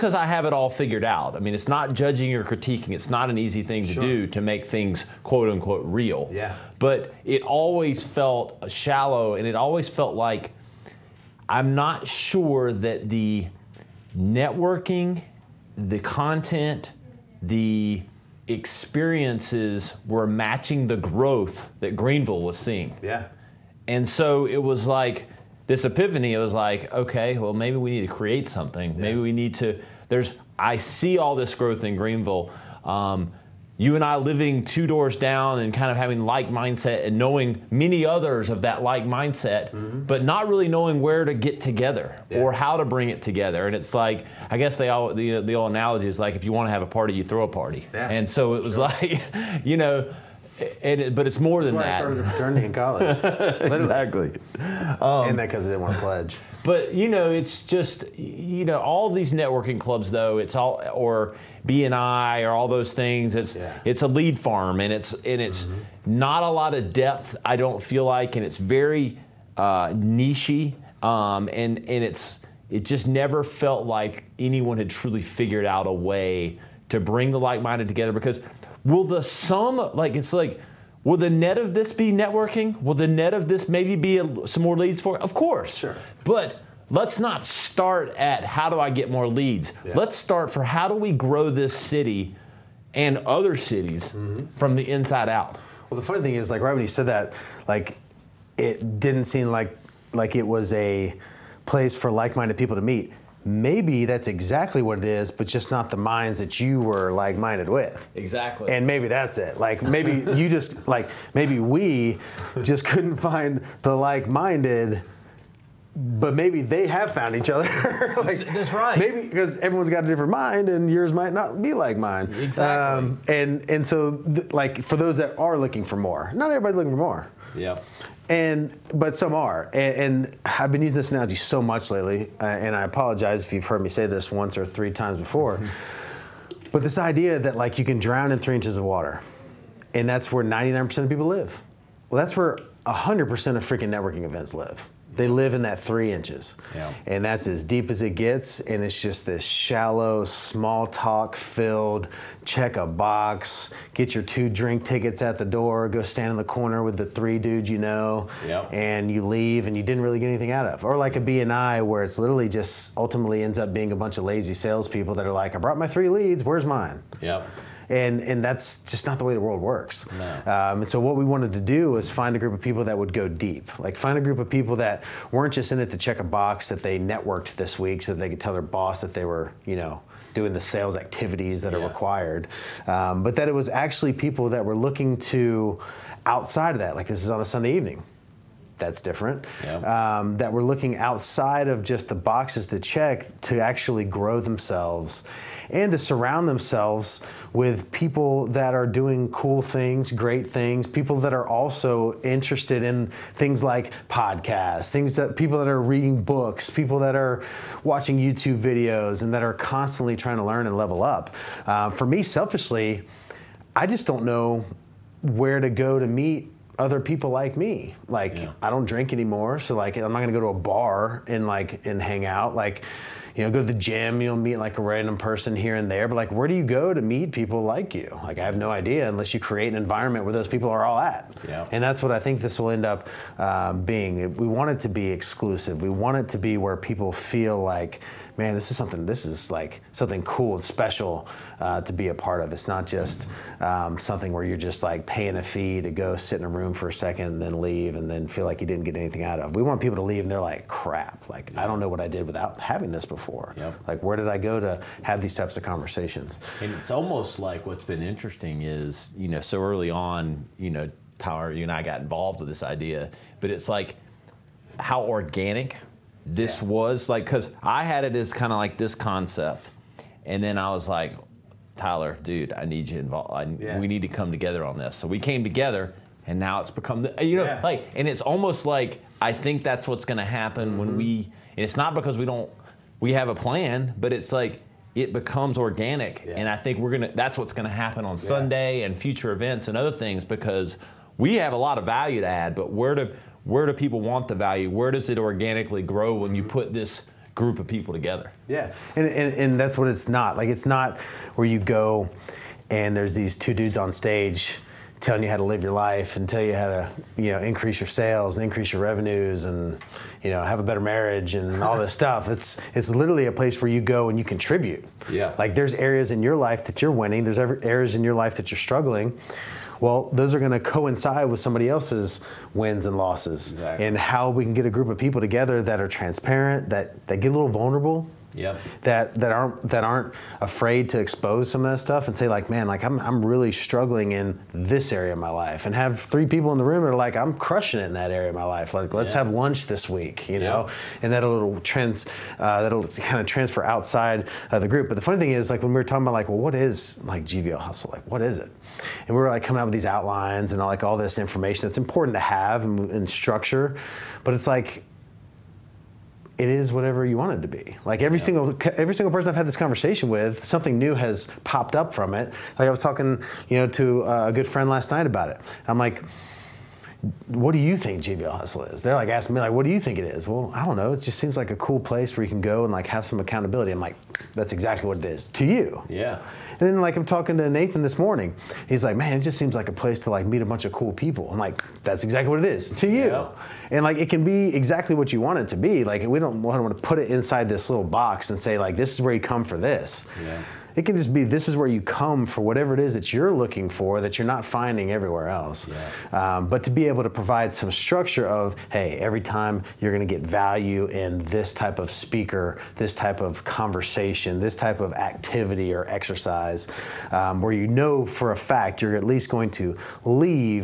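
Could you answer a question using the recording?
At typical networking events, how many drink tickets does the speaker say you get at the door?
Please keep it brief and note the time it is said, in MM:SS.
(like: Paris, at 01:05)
2, at 02:34.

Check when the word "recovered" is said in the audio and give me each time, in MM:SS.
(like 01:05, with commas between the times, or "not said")
not said.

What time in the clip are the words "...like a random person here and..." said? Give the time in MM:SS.
03:44.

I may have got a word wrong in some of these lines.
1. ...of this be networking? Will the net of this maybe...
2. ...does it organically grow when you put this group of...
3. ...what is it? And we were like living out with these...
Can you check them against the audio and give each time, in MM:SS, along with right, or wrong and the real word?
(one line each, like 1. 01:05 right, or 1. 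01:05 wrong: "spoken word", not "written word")
1. 01:21 right
2. 04:54 right
3. 05:48 wrong: "coming", not "living".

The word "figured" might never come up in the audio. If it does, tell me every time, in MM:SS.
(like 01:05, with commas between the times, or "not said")
00:00, 01:15.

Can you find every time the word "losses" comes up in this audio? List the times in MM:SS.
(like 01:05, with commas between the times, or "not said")
05:22.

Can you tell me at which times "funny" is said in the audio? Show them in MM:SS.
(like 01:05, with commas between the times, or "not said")
01:36, 05:45.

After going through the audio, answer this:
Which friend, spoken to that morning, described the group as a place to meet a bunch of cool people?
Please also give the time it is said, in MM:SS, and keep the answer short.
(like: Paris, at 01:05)
Nathan, at 06:17.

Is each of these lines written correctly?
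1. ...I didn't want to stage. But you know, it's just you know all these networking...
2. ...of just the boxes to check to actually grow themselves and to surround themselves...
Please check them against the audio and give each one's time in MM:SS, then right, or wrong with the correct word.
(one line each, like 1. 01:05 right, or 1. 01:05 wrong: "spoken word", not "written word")
1. 00:55 wrong: "pledge", not "stage"
2. 03:11 right.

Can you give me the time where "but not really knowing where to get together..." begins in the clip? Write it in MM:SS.
00:40.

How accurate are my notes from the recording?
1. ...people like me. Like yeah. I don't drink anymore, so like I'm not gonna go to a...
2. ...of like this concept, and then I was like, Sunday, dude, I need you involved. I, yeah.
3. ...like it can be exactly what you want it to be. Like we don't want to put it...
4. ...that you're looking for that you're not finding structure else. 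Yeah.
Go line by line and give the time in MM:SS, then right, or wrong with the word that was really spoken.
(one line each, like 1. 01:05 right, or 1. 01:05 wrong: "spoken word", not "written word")
1. 03:36 right
2. 04:28 wrong: "Tyler", not "Sunday"
3. 06:23 right
4. 06:32 wrong: "everywhere", not "structure".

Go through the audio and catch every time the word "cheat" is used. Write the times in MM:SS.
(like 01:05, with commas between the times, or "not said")
not said.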